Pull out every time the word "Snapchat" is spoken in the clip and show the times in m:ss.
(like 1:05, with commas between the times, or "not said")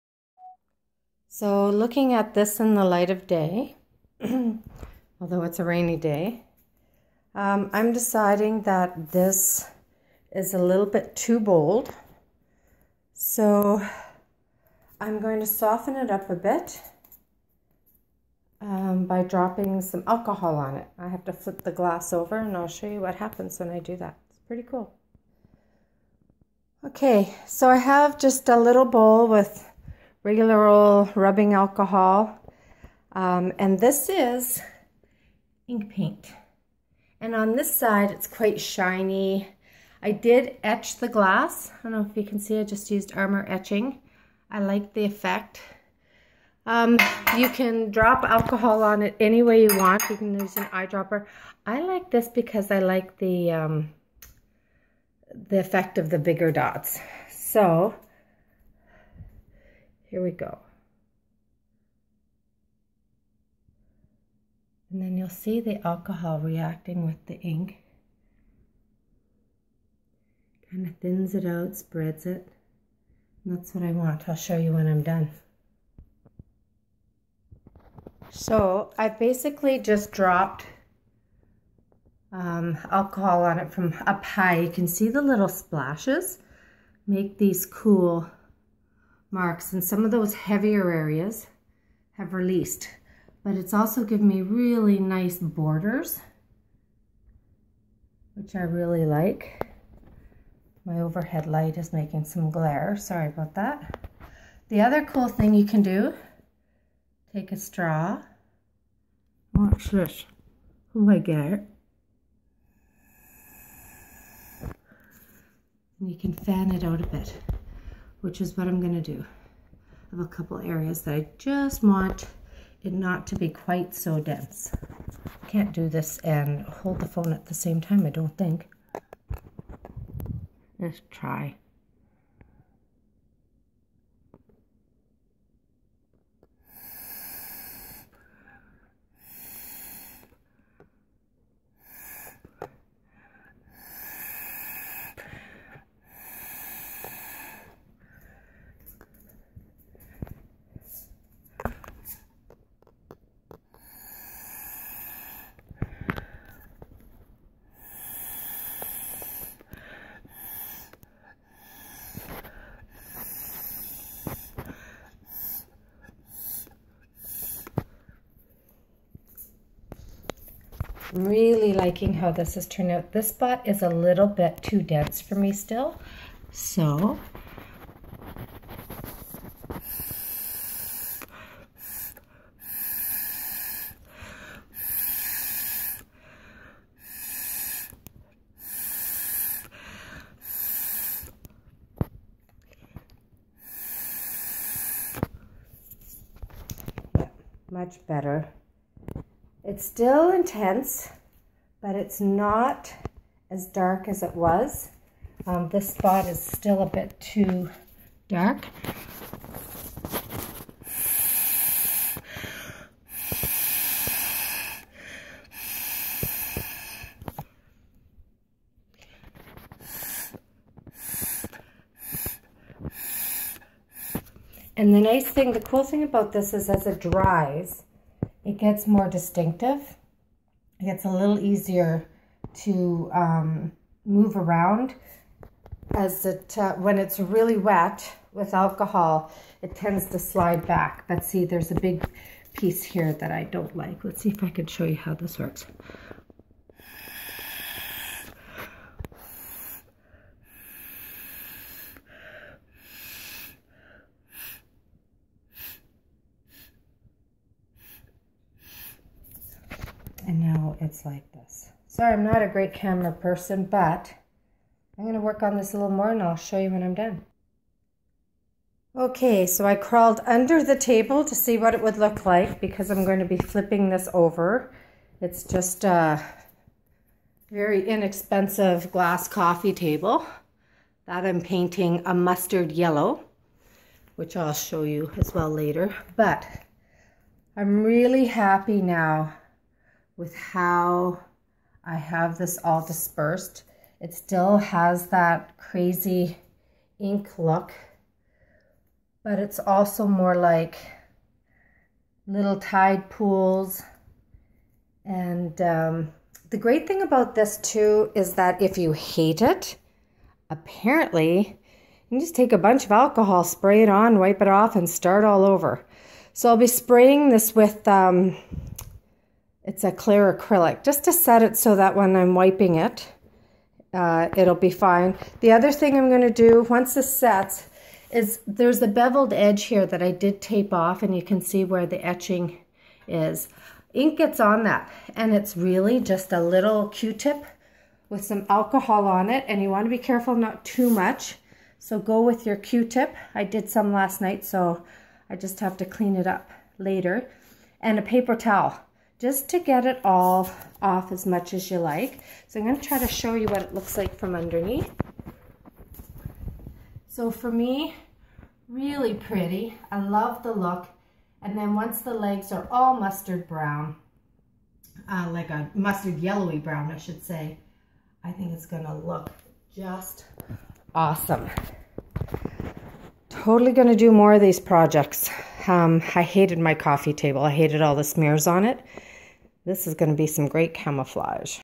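not said.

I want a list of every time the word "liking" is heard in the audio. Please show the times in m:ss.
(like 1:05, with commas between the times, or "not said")
2:51.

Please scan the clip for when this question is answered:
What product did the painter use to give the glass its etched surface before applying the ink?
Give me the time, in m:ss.
0:43.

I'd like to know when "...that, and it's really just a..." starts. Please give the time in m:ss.
5:34.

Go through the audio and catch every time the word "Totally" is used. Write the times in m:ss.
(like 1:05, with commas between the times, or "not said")
6:13.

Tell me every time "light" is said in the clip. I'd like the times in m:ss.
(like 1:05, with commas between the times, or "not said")
0:02, 1:41.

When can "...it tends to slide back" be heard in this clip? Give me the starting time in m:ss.
3:59.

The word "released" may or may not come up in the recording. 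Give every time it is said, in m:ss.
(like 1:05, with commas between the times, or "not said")
1:32.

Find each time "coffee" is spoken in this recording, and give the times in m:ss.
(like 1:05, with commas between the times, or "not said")
4:39, 6:16.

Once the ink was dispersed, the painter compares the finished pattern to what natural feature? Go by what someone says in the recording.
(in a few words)
tide pools.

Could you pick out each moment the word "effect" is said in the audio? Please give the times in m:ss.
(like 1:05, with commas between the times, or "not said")
0:45, 0:55.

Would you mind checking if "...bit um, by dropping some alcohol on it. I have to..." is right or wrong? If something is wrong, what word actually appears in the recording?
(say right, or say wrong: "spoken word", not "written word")
right.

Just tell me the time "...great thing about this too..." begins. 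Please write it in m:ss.
5:06.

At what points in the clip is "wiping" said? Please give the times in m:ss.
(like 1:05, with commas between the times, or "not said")
5:22.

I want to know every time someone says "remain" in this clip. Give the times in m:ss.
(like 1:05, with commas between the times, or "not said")
not said.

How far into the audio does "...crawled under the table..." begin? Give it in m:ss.
4:29.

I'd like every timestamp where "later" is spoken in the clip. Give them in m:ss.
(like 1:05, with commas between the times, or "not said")
4:45, 5:46.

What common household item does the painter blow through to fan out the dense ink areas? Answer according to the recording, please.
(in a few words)
a straw.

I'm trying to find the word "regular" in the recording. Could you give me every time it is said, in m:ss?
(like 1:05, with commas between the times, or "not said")
0:30.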